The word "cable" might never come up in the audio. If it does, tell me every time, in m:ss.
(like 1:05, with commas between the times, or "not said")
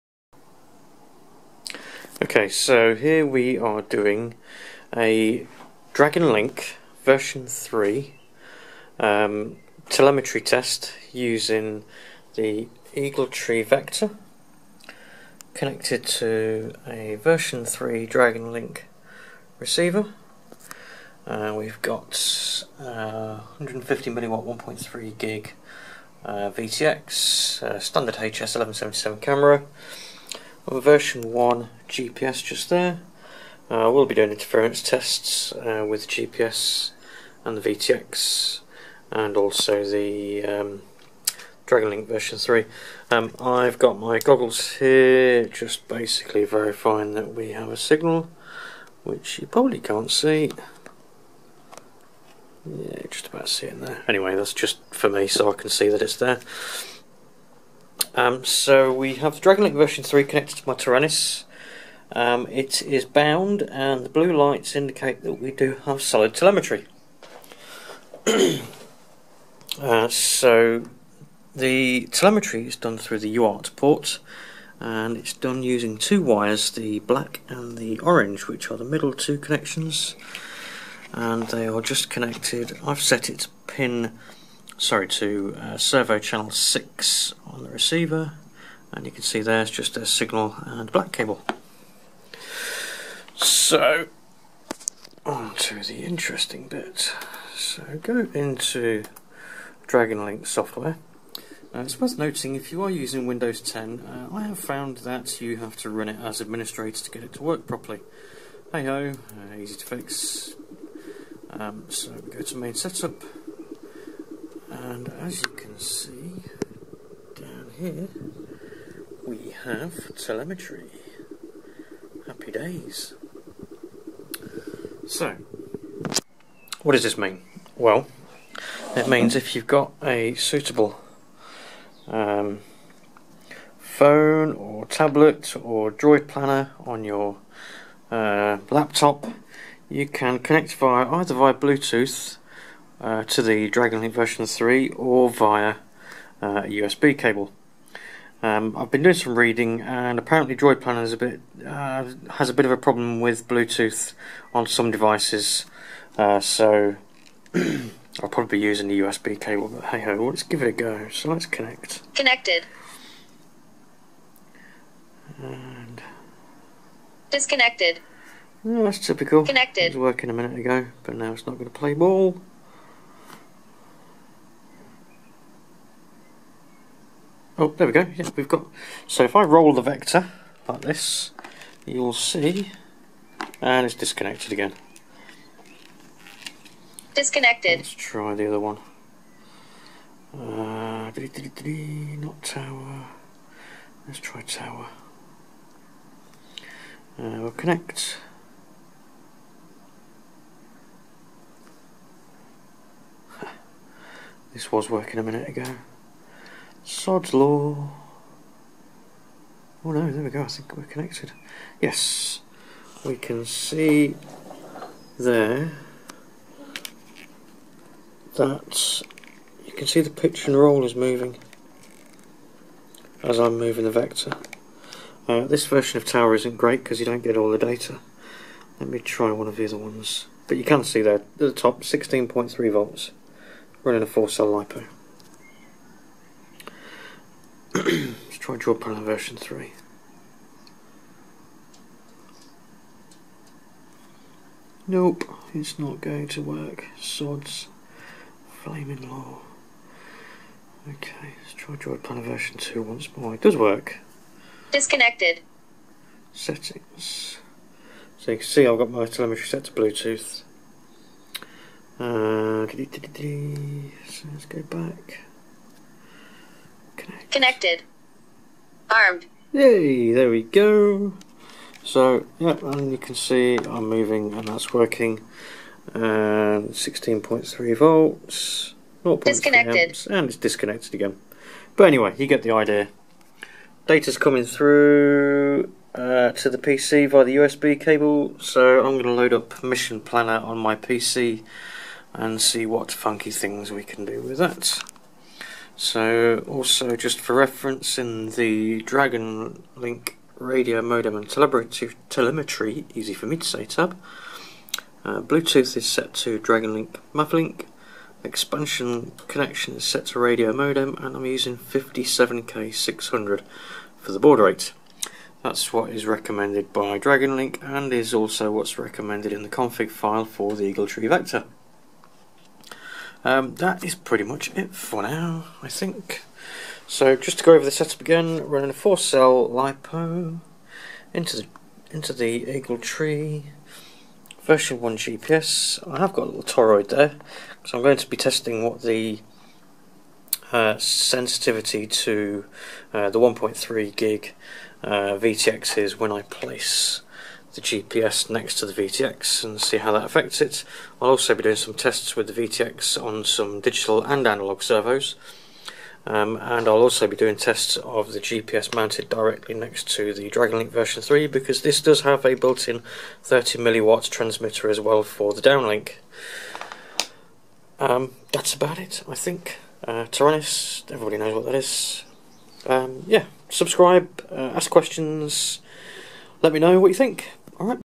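1:31, 2:27, 2:39, 4:47.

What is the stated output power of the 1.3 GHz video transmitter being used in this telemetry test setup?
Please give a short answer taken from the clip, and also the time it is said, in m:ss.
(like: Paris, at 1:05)
150 milliwatts, at 0:23.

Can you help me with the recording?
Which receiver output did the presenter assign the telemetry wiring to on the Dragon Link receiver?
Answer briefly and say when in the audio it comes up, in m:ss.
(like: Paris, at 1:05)
Servo channel 6, at 1:25.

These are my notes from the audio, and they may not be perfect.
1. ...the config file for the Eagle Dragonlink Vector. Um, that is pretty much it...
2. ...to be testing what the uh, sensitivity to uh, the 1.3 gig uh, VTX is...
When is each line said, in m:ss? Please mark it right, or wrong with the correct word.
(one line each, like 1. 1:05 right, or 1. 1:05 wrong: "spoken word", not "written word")
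1. 5:19 wrong: "Tree", not "Dragonlink"
2. 5:37 right.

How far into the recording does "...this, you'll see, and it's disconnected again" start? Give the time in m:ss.
3:00.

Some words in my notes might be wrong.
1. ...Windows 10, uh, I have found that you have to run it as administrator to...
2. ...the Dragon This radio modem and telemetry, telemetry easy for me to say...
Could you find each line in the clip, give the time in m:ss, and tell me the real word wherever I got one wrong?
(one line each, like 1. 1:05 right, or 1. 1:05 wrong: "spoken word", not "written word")
1. 1:43 right
2. 4:58 wrong: "Link", not "This".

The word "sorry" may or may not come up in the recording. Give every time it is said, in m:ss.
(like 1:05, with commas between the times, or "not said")
1:24.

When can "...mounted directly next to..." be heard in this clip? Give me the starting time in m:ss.
5:58.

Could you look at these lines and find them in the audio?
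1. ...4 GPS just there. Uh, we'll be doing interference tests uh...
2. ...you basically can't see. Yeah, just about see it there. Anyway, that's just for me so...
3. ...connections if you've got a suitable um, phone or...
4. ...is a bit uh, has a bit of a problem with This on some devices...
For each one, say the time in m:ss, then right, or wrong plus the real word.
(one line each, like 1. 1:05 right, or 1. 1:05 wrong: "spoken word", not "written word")
1. 0:31 wrong: "1", not "4"
2. 0:49 wrong: "probably", not "basically"
3. 2:09 wrong: "means", not "connections"
4. 2:31 wrong: "Bluetooth", not "This".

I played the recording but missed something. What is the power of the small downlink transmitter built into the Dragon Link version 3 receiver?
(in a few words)
30 milliwatts.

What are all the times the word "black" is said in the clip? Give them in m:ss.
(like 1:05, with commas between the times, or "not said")
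1:16, 1:30.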